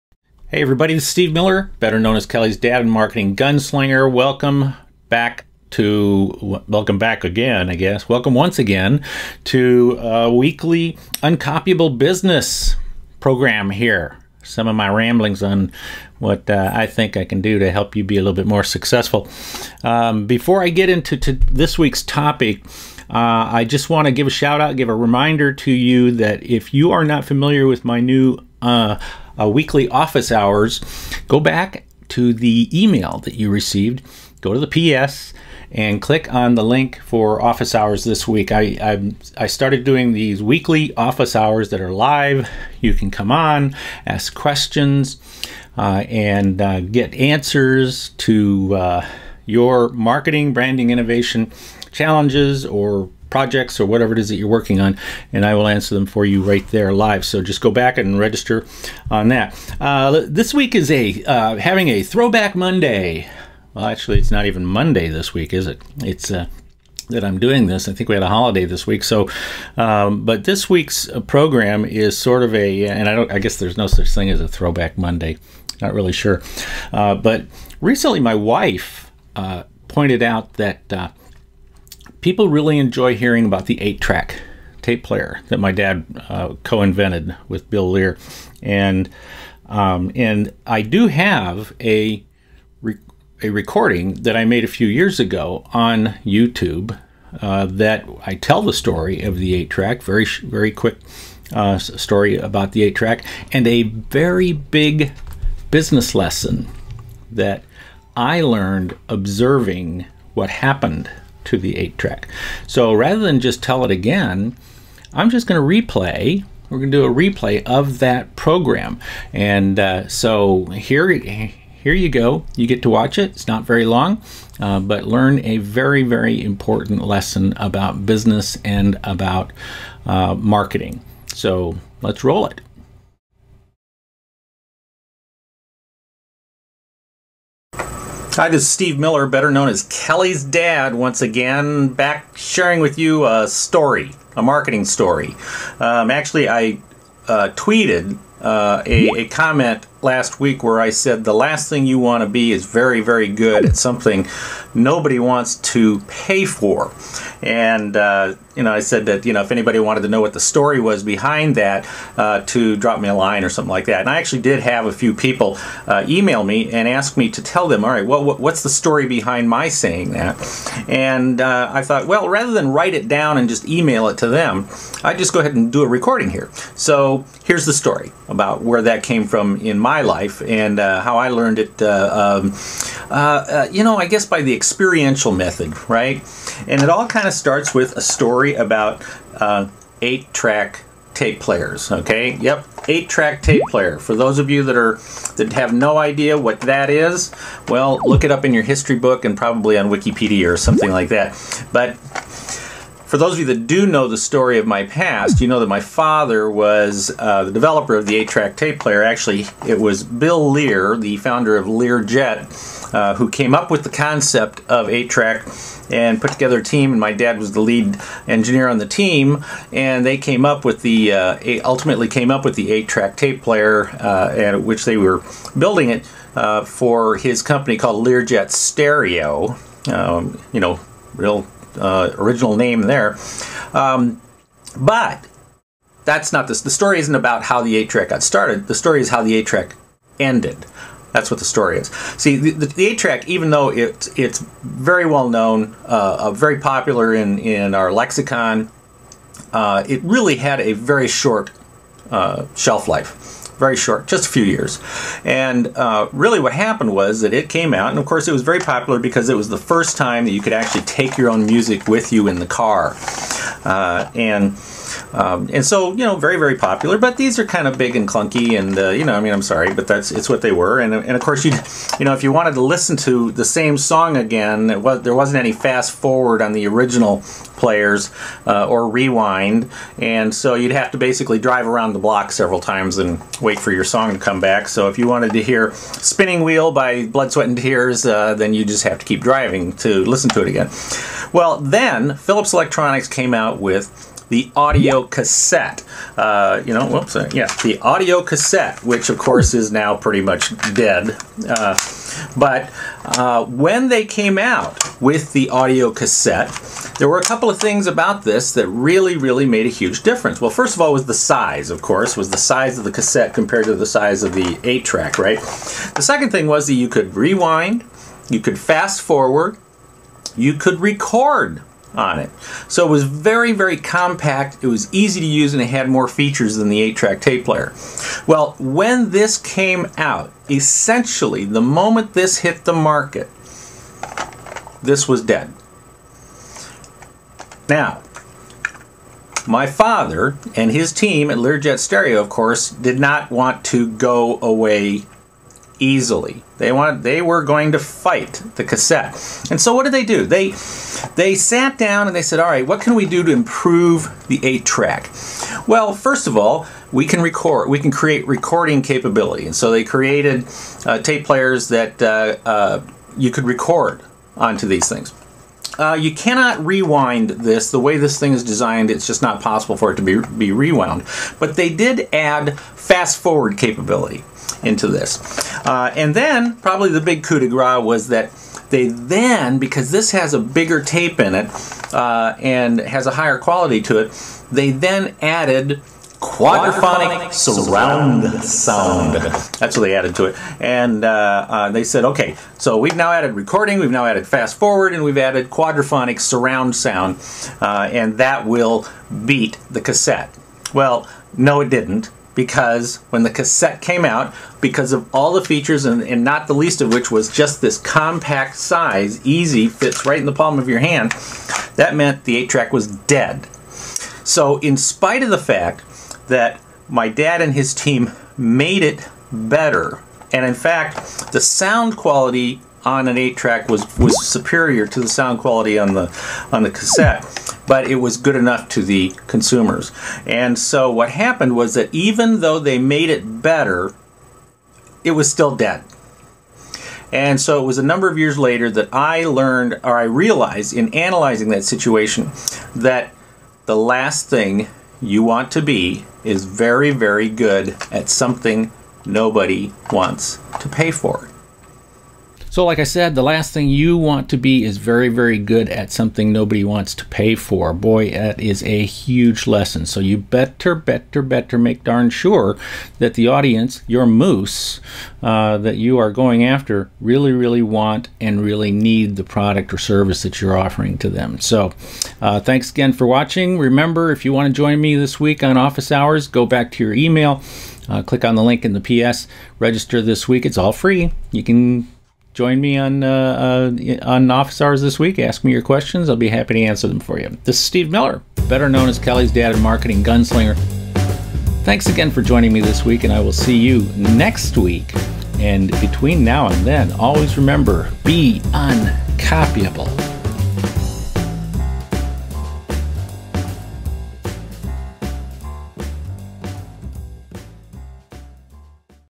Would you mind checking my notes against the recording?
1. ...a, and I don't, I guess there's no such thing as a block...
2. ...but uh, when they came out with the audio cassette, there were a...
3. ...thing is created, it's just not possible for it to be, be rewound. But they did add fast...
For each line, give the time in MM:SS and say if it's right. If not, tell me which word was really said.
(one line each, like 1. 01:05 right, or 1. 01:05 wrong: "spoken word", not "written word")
1. 01:12 wrong: "throwback", not "block"
2. 05:02 right
3. 06:08 wrong: "designed", not "created".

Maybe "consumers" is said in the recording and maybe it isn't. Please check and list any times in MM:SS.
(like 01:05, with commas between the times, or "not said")
07:09.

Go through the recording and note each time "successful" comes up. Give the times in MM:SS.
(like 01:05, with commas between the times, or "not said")
00:18.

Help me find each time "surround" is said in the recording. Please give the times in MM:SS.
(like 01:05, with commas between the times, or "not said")
06:27, 06:36.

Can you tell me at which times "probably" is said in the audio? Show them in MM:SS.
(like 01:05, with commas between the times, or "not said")
03:19, 06:16.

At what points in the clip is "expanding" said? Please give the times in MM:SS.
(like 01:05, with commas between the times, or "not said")
not said.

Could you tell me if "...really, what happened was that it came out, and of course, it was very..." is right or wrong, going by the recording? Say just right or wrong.
right.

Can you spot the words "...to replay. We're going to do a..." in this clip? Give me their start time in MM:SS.
01:55.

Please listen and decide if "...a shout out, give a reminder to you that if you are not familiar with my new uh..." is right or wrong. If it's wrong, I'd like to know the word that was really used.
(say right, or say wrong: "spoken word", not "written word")
right.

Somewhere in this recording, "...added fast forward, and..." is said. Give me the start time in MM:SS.
06:34.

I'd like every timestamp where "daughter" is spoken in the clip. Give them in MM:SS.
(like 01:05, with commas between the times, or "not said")
not said.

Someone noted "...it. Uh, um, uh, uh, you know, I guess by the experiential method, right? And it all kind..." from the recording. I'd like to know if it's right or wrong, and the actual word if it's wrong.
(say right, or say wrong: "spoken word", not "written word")
right.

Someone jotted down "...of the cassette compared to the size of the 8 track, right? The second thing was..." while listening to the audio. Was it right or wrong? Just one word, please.
right.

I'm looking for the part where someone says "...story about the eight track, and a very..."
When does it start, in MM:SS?
01:41.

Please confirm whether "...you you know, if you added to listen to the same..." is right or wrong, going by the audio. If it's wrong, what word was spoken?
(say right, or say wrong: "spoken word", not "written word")
wrong: "wanted", not "added".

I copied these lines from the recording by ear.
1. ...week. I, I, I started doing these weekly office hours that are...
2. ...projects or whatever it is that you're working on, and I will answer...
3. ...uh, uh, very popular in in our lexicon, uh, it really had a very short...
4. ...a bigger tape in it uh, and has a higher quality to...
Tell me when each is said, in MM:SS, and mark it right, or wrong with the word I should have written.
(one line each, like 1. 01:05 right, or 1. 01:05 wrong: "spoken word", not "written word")
1. 00:38 right
2. 00:53 right
3. 04:05 right
4. 06:20 right.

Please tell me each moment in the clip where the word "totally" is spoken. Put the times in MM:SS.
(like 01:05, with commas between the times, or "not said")
not said.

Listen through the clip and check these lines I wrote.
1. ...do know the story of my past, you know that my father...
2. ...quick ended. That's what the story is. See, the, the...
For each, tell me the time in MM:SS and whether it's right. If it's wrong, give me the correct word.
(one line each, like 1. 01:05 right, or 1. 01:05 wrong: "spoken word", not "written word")
1. 03:23 right
2. 03:59 wrong: "track", not "quick".